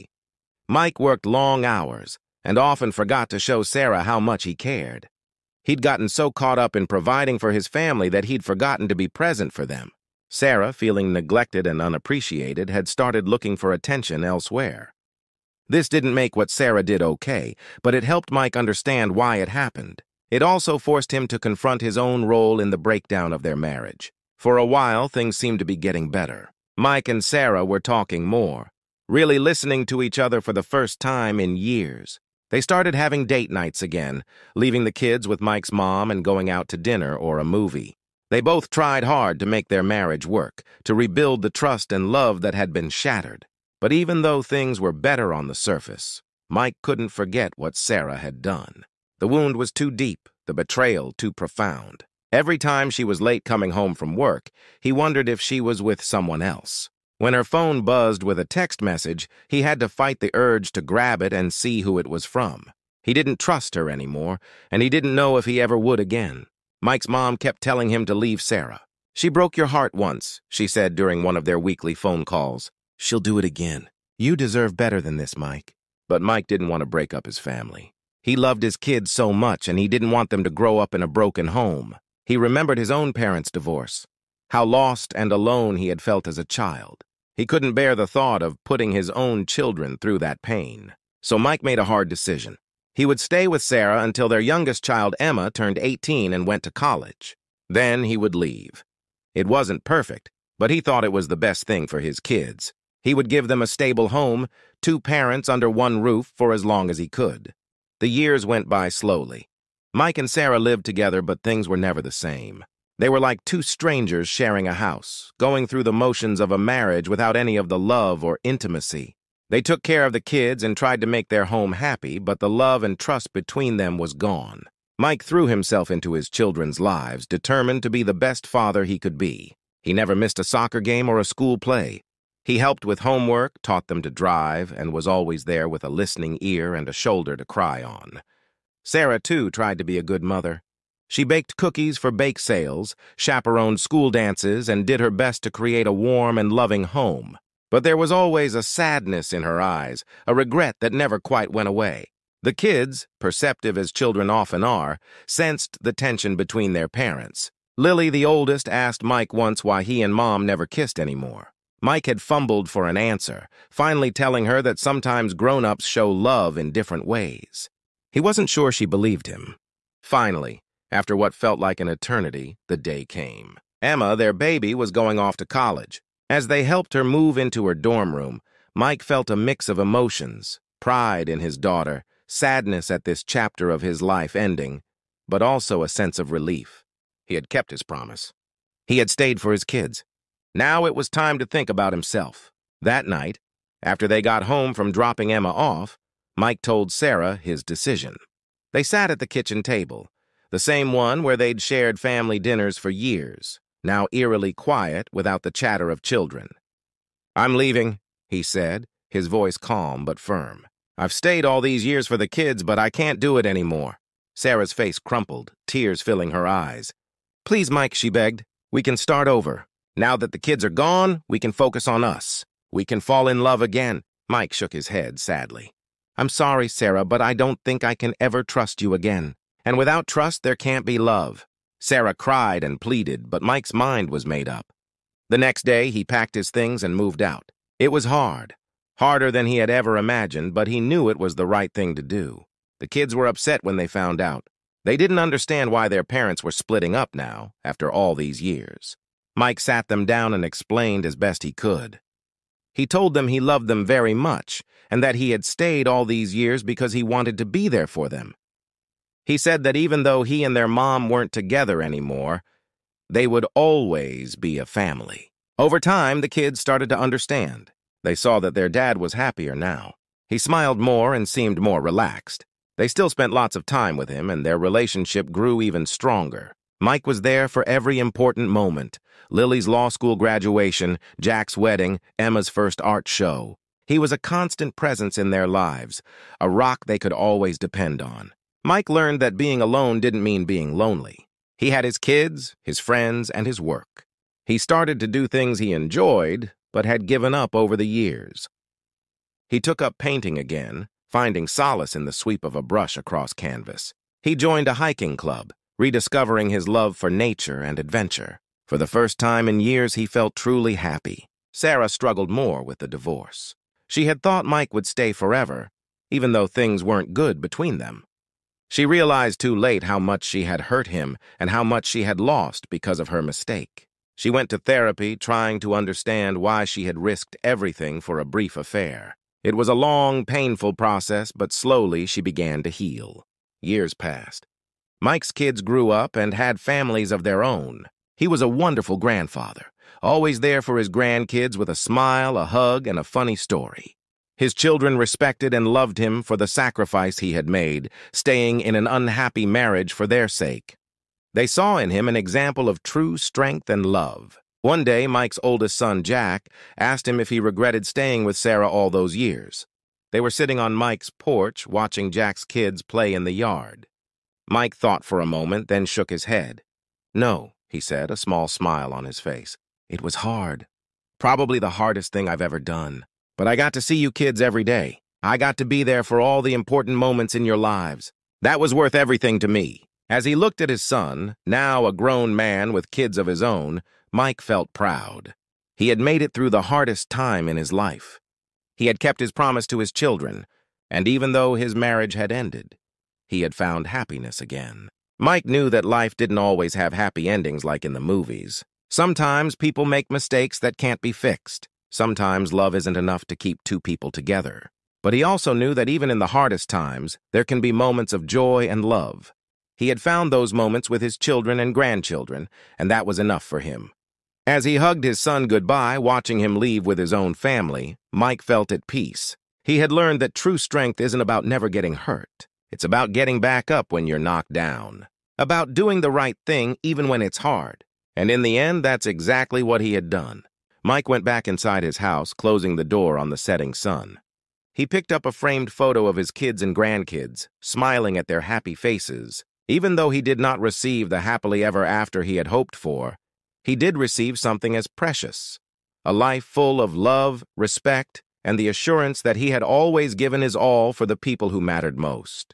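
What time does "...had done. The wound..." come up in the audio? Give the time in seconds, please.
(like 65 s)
48 s.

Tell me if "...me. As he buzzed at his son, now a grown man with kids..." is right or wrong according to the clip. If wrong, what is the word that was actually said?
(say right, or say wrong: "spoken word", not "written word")
wrong: "looked", not "buzzed".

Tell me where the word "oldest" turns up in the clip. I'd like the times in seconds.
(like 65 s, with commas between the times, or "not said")
158 s, 355 s.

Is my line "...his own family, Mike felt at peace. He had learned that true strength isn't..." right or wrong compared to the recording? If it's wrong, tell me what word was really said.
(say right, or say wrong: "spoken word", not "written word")
right.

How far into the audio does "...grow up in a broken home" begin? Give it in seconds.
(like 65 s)
80 s.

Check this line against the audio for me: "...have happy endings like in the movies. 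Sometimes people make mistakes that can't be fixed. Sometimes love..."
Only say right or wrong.
right.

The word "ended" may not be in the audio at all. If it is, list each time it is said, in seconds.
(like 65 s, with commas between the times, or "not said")
392 s.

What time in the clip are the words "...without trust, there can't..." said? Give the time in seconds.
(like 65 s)
229 s.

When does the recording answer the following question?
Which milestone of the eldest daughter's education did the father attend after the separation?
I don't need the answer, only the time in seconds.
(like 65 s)
279 s.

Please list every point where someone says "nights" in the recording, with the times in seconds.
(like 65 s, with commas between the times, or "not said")
33 s, 193 s.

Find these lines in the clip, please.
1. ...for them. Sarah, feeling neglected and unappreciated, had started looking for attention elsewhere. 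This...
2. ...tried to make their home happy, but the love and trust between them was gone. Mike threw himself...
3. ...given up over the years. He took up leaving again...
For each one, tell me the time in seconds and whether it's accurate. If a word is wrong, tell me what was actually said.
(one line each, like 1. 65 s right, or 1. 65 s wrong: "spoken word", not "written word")
1. 9 s right
2. 120 s right
3. 297 s wrong: "painting", not "leaving".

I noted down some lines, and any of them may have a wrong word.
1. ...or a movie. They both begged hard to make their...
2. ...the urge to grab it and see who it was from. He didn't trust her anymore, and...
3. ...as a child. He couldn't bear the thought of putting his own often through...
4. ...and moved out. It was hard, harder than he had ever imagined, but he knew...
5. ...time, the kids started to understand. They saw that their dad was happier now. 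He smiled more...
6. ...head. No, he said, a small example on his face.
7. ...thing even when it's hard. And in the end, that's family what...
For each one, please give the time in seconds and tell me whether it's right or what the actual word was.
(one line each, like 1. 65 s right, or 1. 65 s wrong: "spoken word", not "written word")
1. 37 s wrong: "tried", not "begged"
2. 60 s right
3. 86 s wrong: "children", not "often"
4. 236 s right
5. 265 s right
6. 366 s wrong: "smile", not "example"
7. 426 s wrong: "exactly", not "family".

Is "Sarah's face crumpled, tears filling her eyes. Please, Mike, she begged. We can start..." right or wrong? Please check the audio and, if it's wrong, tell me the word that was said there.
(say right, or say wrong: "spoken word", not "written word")
right.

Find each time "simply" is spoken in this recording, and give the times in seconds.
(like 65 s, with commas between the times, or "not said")
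not said.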